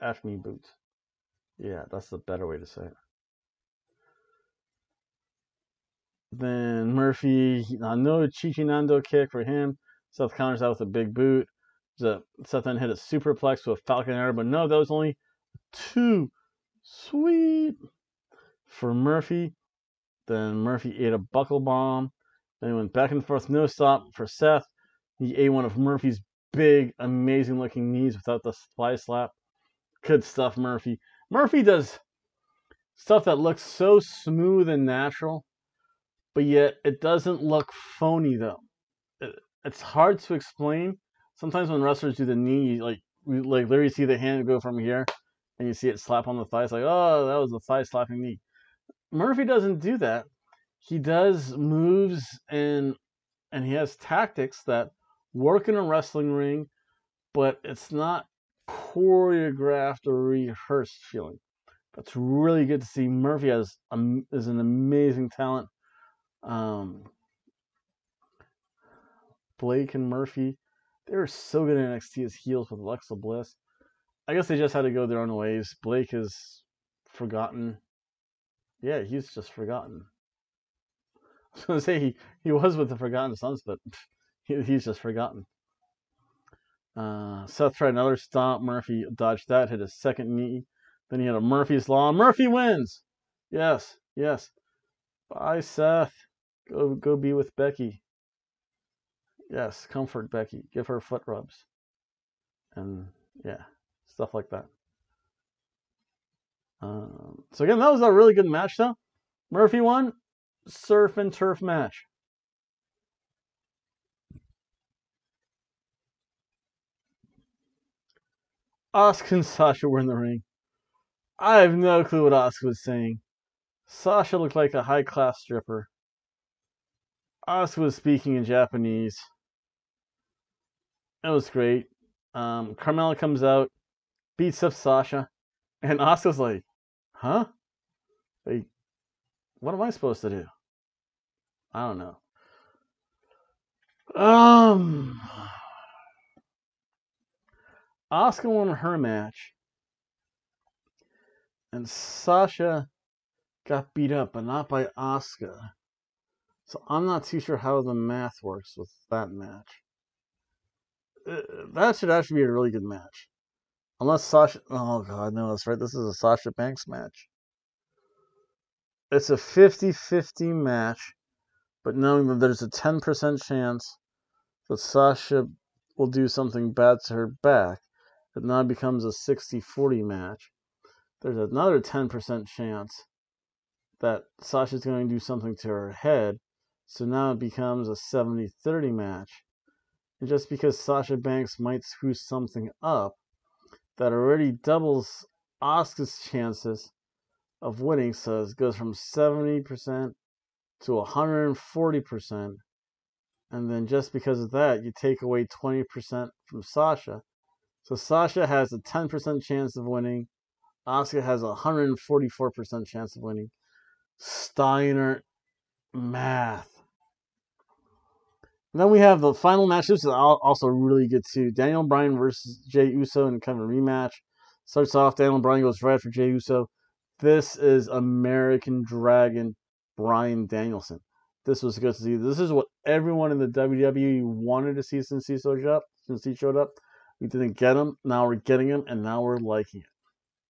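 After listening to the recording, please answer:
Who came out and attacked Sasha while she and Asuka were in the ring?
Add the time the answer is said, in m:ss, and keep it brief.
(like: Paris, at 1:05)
Carmella, at 2:12.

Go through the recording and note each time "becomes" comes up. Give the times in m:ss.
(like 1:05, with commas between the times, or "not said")
2:58, 3:07.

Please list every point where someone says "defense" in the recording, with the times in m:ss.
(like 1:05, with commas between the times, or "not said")
not said.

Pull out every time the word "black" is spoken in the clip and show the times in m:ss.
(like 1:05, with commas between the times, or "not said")
not said.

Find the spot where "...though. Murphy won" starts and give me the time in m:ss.
1:48.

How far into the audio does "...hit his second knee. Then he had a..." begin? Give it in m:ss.
1:29.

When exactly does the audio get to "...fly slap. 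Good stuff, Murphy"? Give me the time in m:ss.
0:28.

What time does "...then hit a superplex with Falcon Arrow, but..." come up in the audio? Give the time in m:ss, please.
0:12.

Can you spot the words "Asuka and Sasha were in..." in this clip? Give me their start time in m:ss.
1:58.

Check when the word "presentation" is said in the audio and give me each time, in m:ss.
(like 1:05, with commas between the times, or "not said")
not said.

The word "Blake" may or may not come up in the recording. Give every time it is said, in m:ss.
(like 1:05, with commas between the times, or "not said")
1:09, 1:15.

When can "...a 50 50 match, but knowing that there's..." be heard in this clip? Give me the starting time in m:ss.
2:49.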